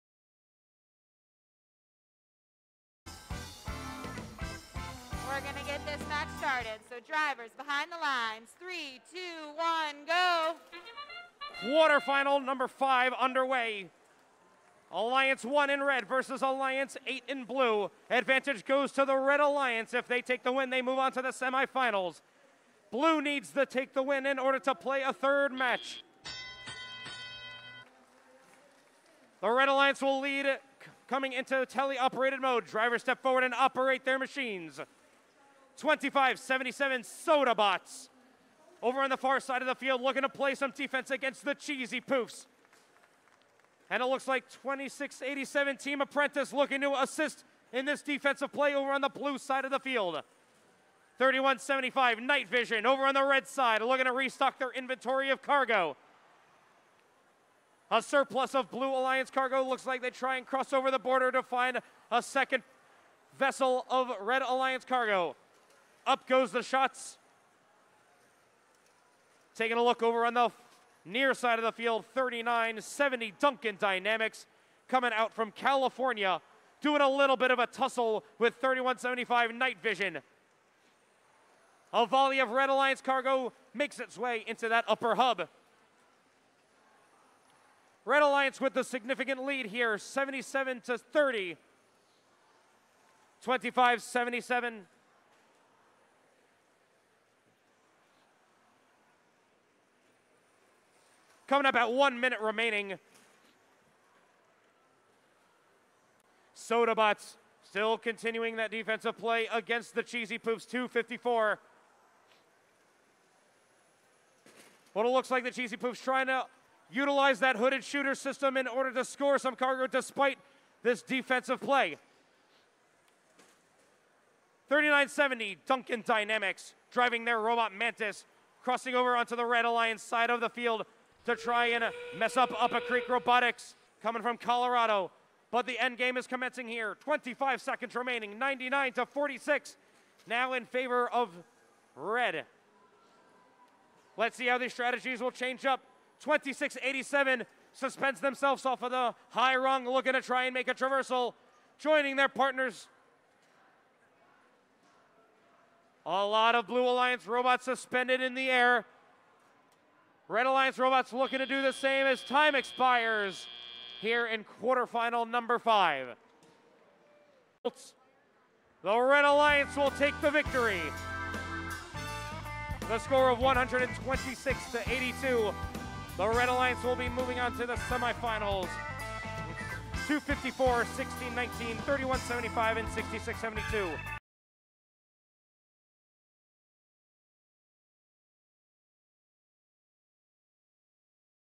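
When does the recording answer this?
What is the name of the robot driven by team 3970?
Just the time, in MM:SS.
02:07.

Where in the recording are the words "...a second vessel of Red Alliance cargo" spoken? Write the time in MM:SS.
01:02.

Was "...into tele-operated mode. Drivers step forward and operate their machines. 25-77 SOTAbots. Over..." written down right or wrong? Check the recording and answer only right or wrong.
right.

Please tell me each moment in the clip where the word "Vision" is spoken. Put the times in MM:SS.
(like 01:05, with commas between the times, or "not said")
00:52, 01:19.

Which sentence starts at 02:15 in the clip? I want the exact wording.
But the end game is commencing here.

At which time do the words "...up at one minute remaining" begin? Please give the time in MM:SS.
01:41.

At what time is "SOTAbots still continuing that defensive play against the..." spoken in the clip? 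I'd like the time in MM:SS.
01:46.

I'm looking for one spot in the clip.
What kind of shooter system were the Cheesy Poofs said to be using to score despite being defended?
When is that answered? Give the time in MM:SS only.
01:57.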